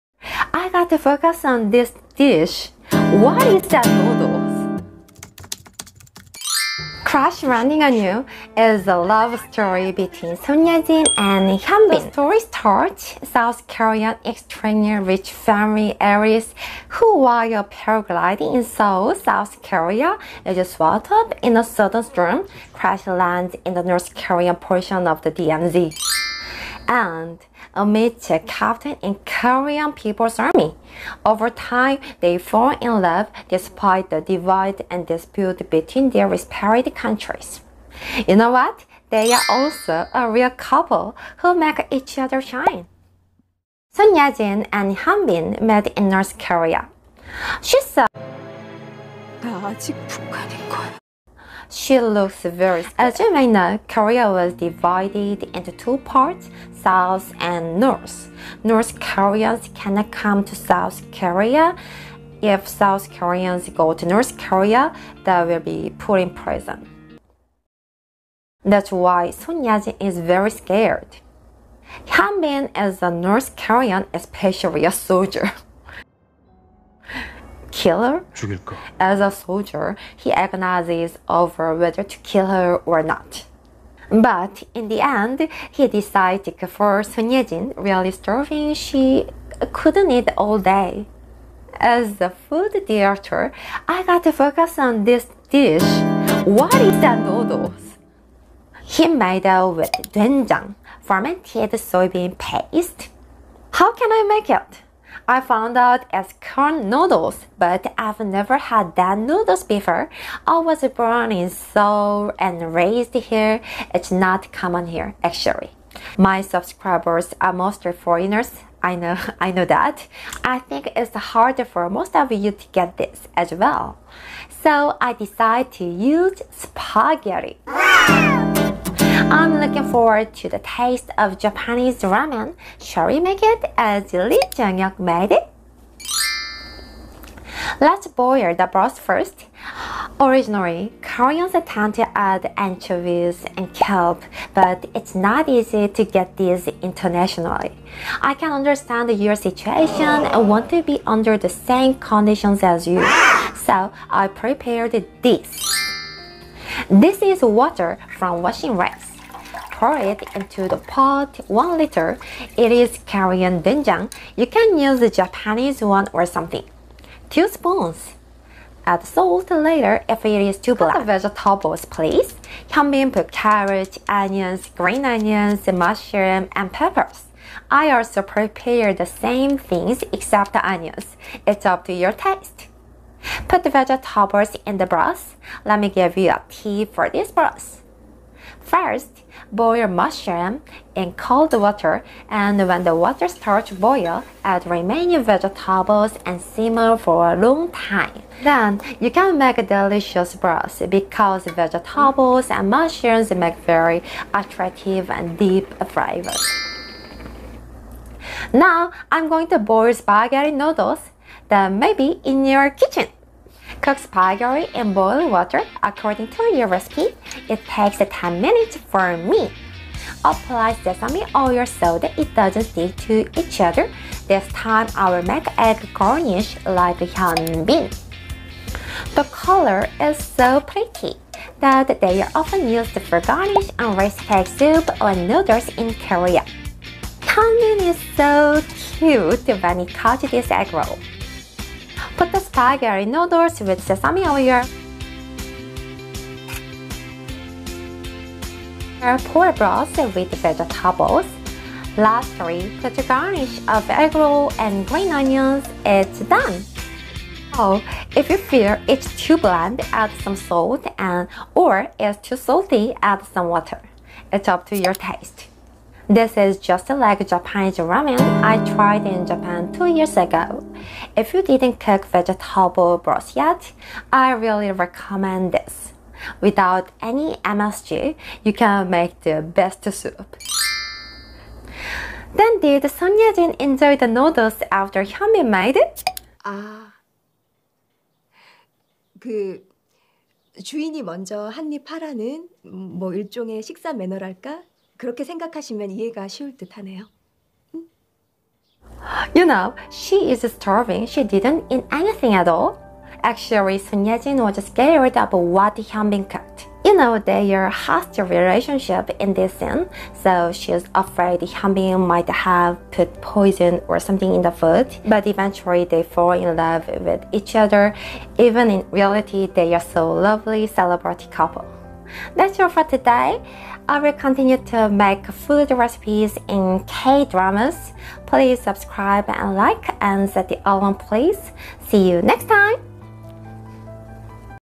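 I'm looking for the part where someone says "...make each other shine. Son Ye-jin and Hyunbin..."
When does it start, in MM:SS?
00:41.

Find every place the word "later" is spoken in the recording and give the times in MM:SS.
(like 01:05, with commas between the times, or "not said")
02:49.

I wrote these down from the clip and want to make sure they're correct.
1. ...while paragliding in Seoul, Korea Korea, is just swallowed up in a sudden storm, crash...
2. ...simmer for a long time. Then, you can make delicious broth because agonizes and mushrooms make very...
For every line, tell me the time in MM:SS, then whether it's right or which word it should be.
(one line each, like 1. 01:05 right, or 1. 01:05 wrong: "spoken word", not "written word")
1. 00:17 wrong: "South", not "Korea"
2. 03:16 wrong: "vegetables", not "agonizes".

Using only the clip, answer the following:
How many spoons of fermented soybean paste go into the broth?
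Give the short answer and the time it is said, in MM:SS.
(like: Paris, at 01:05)
2, at 02:47.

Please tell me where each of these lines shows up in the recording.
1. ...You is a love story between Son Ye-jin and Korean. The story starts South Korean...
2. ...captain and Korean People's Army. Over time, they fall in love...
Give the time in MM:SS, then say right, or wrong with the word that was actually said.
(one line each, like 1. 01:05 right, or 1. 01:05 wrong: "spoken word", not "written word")
1. 00:07 wrong: "Hyunbin", not "Korean"
2. 00:28 right.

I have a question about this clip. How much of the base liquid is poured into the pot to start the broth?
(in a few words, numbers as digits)
1 liter.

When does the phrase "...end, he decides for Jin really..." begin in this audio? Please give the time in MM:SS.
01:25.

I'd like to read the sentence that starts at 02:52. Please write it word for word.
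Hyunbin put carrot, onions, green onions, mushroom, and peppers.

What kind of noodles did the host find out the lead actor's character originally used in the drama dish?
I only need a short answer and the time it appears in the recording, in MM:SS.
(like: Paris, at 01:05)
corn noodles, at 01:46.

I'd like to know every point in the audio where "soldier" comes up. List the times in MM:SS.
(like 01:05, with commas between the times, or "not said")
01:14, 01:19.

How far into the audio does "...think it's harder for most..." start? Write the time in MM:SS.
02:00.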